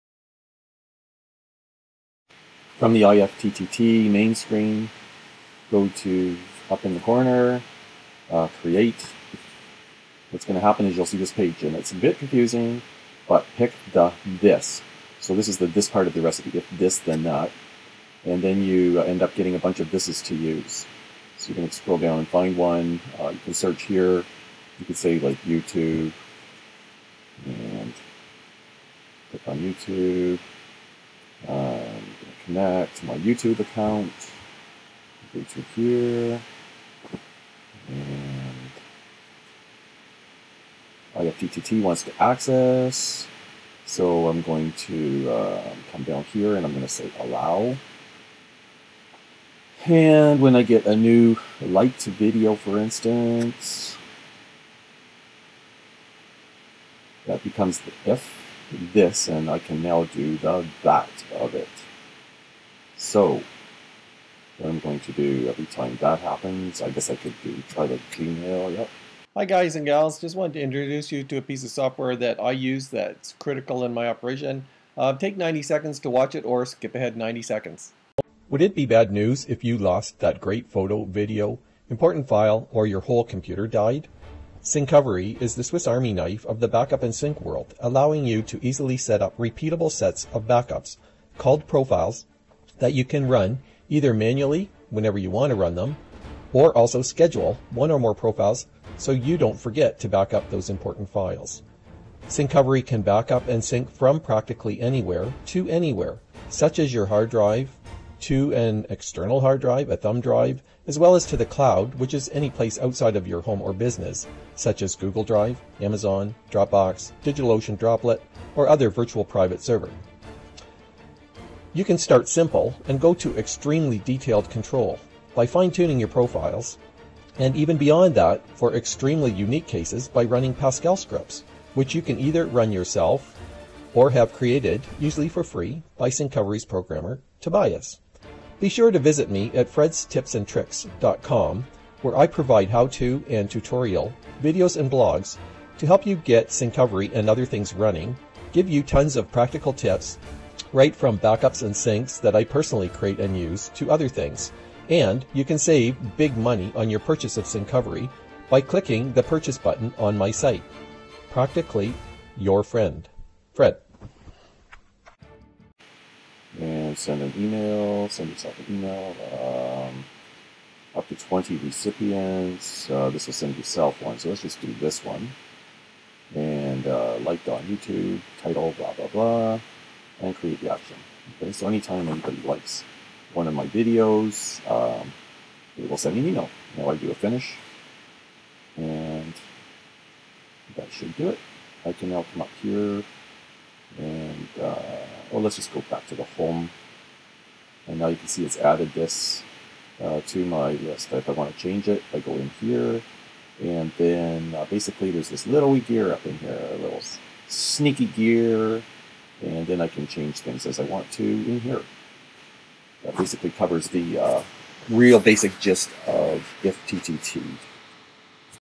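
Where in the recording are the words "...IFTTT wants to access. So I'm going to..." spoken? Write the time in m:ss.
0:41.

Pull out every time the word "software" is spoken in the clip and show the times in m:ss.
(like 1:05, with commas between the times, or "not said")
1:11.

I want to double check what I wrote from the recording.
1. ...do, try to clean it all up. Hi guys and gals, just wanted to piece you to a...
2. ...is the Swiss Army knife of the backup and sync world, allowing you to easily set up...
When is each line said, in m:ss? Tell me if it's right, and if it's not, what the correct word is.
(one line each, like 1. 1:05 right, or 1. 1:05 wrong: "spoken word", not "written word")
1. 1:07 wrong: "introduce", not "piece"
2. 1:25 right.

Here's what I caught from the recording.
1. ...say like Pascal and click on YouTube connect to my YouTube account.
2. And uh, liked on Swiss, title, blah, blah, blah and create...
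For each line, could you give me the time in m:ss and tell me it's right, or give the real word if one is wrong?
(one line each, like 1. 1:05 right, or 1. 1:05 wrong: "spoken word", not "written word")
1. 0:24 wrong: "YouTube", not "Pascal"
2. 2:56 wrong: "YouTube", not "Swiss".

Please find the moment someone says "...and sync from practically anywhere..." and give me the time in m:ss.
1:43.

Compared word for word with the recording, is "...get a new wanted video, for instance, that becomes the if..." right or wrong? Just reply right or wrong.
wrong.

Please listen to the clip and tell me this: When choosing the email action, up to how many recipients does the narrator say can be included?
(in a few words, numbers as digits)
20.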